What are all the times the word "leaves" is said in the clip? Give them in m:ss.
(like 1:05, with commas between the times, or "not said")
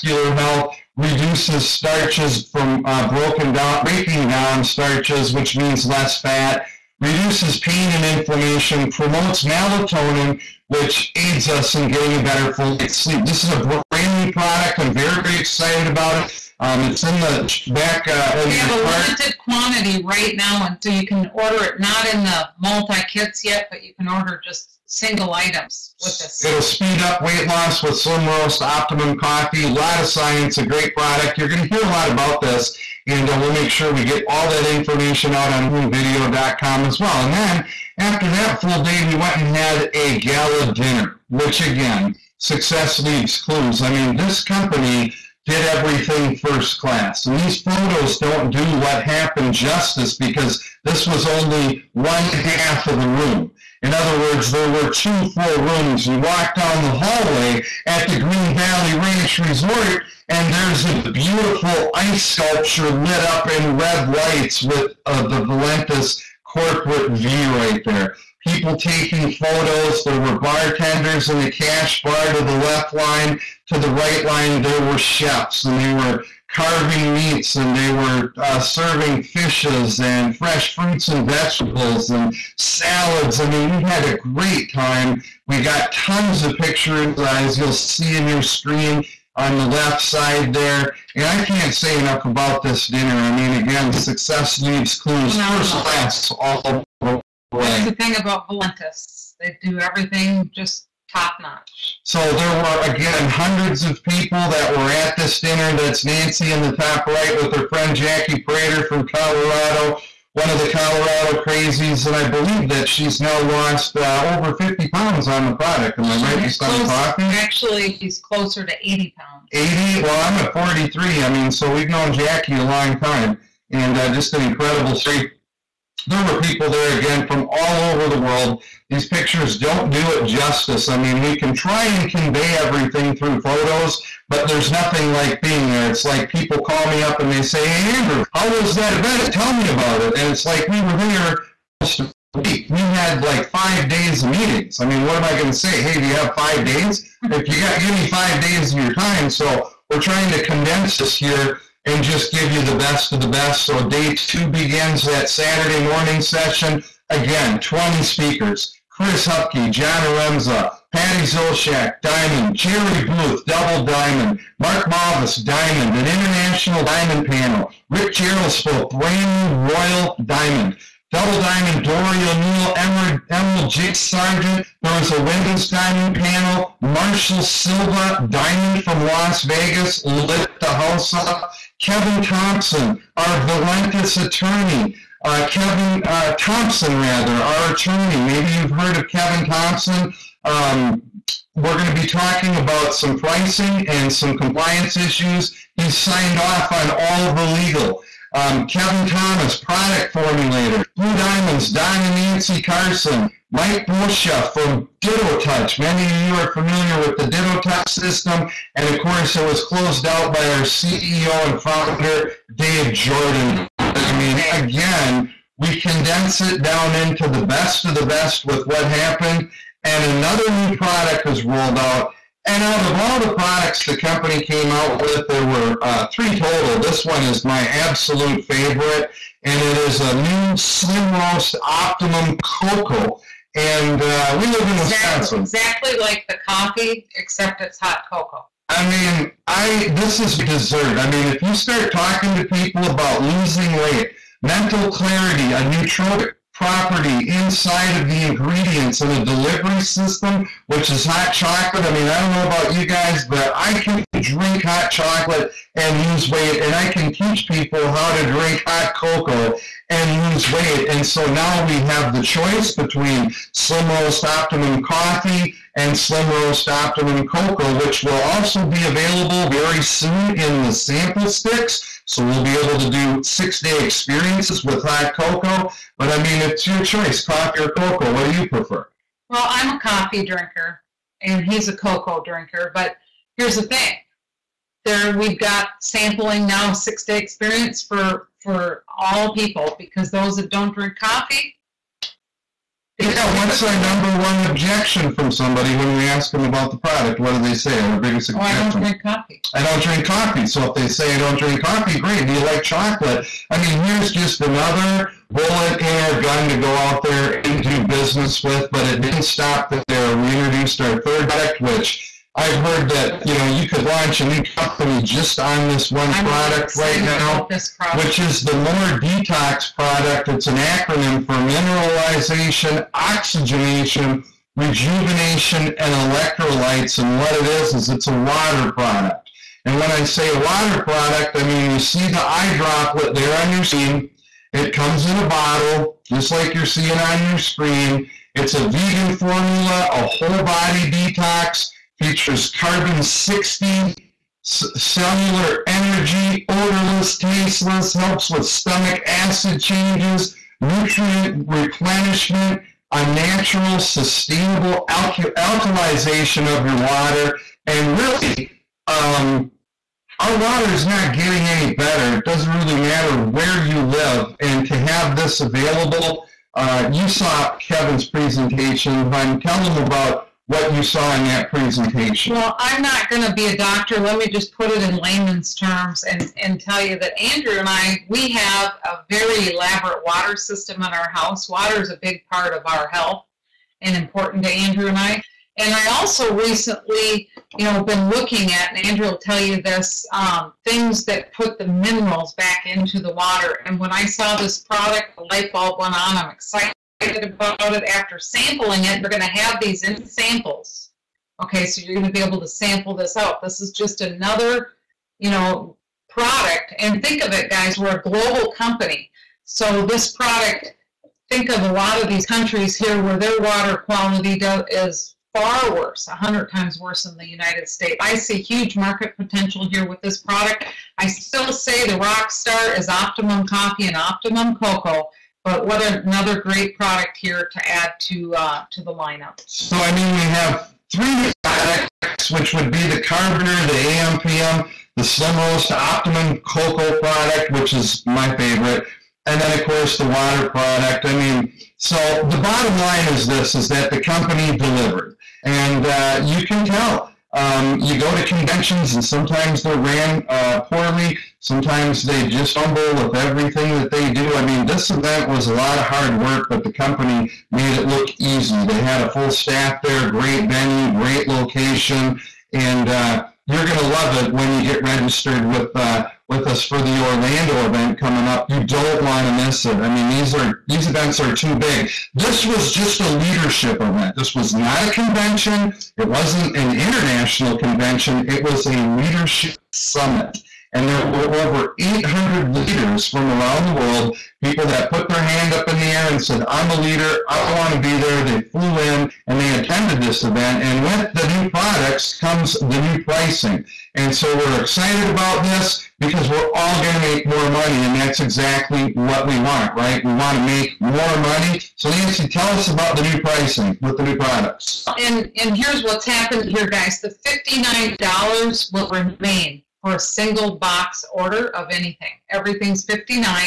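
0:43, 1:34.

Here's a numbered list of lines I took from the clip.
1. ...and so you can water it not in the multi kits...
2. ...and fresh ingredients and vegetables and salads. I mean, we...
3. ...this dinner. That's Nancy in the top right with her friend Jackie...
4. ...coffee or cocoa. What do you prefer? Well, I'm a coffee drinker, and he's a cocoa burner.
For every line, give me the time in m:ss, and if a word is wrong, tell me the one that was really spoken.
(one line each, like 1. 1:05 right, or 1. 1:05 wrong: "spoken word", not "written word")
1. 0:20 wrong: "order", not "water"
2. 1:19 wrong: "fruits", not "ingredients"
3. 1:45 right
4. 4:37 wrong: "drinker", not "burner".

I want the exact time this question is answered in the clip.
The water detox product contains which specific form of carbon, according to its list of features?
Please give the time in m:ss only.
5:42.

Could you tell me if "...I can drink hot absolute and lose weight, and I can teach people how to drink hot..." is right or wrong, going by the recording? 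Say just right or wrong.
wrong.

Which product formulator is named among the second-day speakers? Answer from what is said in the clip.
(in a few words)
Kevin Thomas.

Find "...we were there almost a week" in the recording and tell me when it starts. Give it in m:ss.
2:20.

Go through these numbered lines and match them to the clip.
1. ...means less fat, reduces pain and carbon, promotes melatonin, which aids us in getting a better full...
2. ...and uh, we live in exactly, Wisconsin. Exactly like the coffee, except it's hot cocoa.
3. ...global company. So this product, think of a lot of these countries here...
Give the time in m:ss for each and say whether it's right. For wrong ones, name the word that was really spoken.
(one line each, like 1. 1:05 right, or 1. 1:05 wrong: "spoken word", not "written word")
1. 0:05 wrong: "inflammation", not "carbon"
2. 3:53 right
3. 6:48 right.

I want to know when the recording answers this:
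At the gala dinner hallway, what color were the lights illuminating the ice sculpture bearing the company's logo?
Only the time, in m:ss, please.
1:03.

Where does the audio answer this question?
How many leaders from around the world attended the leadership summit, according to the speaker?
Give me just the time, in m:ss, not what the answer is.
8:01.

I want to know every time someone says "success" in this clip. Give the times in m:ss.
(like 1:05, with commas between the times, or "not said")
0:42, 1:33.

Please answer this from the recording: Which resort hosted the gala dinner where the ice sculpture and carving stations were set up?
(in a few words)
Green Valley Ranch Resort.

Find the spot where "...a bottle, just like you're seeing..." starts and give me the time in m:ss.
5:35.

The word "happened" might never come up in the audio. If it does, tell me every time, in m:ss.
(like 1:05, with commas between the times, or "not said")
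0:49, 3:38, 8:26.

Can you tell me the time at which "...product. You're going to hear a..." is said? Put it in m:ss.
0:30.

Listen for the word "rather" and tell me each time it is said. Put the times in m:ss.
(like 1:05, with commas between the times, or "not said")
3:06.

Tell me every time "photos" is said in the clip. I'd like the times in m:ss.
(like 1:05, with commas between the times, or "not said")
0:47, 1:09, 2:13.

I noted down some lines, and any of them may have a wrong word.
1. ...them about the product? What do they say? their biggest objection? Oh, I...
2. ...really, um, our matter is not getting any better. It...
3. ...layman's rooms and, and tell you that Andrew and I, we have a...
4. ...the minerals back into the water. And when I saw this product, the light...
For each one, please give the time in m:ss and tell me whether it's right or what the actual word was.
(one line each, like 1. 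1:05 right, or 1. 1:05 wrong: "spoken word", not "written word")
1. 4:56 right
2. 5:57 wrong: "water", not "matter"
3. 6:14 wrong: "terms", not "rooms"
4. 6:31 right.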